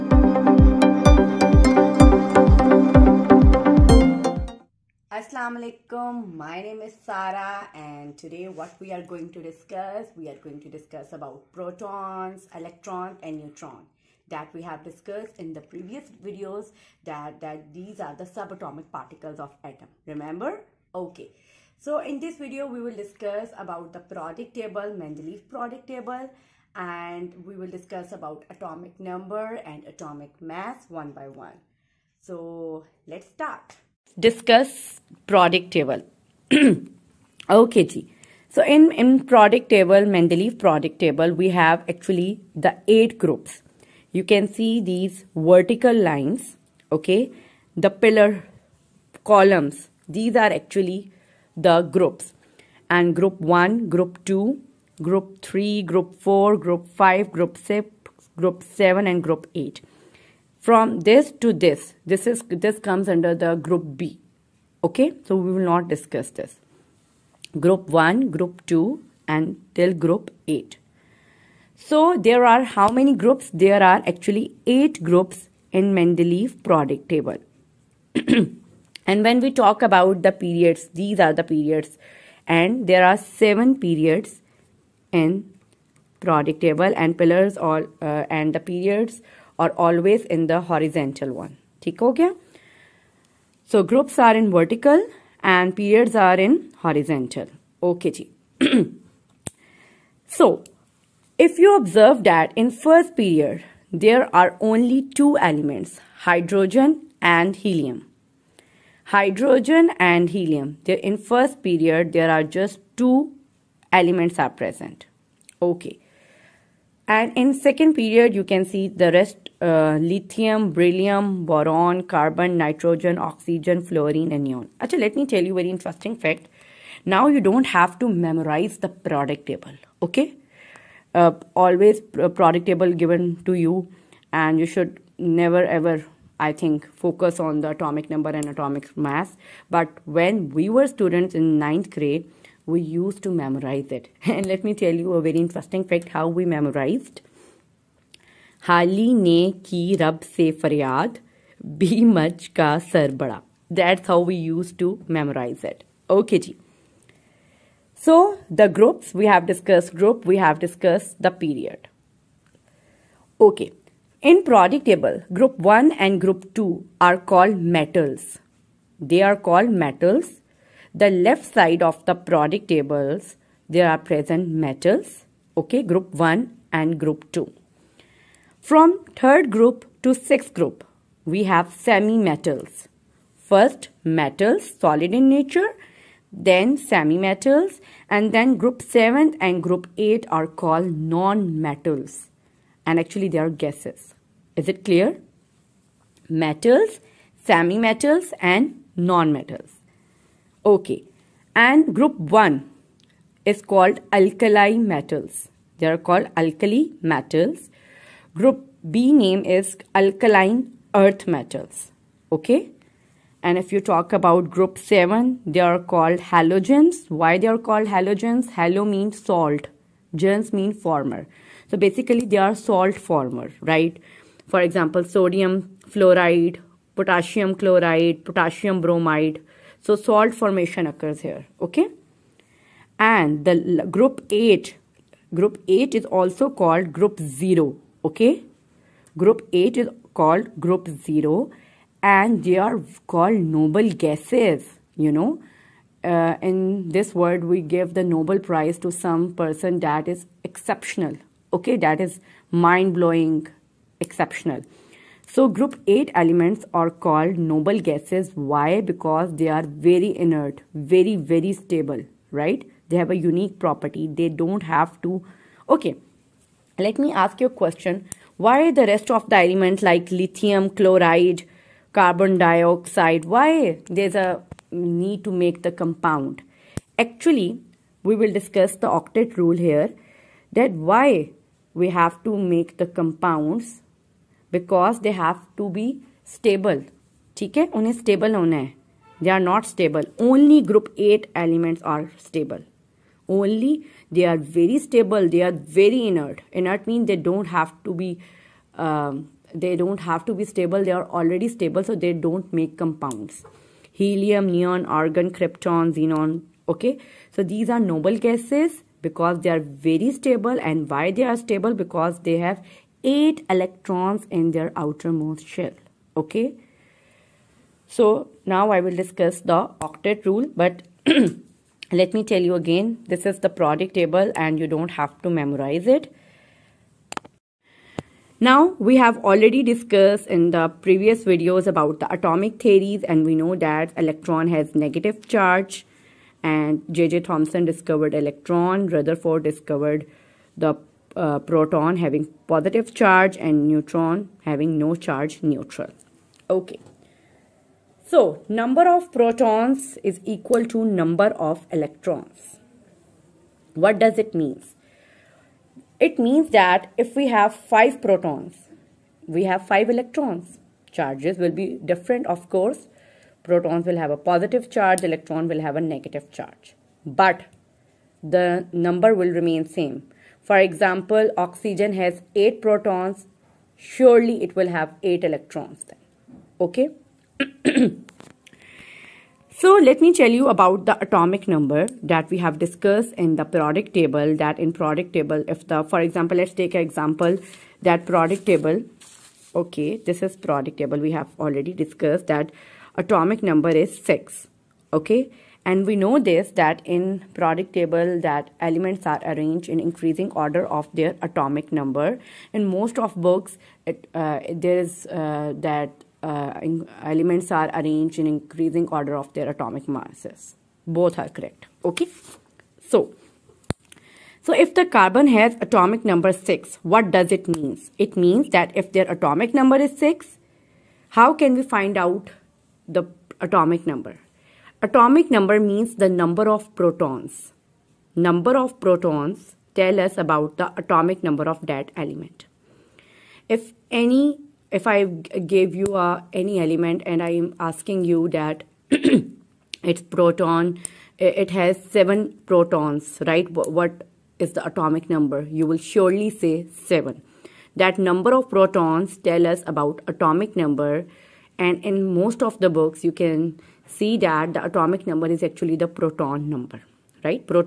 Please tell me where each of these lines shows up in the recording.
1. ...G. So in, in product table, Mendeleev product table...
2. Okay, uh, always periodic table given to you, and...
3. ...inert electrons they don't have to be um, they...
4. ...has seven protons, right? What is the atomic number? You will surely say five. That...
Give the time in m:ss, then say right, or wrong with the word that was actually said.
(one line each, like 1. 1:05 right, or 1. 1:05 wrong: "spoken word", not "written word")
1. 0:37 right
2. 2:10 right
3. 4:56 wrong: "means", not "electrons"
4. 7:21 wrong: "seven", not "five".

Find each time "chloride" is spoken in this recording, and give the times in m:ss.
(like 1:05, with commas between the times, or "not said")
3:47, 4:30.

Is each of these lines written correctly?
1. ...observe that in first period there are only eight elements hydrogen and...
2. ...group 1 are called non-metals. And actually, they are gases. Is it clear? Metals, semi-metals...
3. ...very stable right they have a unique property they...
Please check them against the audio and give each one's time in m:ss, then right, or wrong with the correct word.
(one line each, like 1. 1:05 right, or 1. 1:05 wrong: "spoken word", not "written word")
1. 1:41 wrong: "two", not "eight"
2. 3:09 wrong: "8", not "1"
3. 4:21 right.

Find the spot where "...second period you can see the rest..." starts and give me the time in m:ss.
1:57.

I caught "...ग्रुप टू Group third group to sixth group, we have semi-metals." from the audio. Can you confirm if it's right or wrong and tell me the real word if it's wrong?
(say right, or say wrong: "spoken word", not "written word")
wrong: "From", not "Group".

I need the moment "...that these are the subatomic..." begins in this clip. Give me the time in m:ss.
0:17.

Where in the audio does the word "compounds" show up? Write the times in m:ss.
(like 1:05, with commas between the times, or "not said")
4:35, 4:42, 5:02.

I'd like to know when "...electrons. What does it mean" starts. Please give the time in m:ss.
5:51.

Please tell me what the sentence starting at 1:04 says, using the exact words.
Okay, so we will not discuss this.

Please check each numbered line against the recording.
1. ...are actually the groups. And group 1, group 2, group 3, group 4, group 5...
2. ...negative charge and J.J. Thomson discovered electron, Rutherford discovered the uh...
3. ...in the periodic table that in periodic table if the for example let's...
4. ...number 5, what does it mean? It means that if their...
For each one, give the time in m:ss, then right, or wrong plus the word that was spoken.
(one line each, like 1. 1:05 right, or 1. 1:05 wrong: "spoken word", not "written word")
1. 0:50 right
2. 5:34 right
3. 6:23 right
4. 6:56 wrong: "6", not "5".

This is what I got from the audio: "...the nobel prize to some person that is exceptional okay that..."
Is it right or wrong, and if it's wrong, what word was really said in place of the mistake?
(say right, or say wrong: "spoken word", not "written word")
right.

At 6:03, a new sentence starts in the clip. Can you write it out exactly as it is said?
Protons will have a positive charge, electron will have a negative charge.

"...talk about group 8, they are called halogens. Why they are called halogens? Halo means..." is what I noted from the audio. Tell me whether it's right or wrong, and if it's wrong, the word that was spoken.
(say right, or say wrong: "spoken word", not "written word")
wrong: "7", not "8".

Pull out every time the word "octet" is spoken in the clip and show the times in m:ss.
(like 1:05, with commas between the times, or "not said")
4:38, 5:19.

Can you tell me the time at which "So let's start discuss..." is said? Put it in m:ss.
0:32.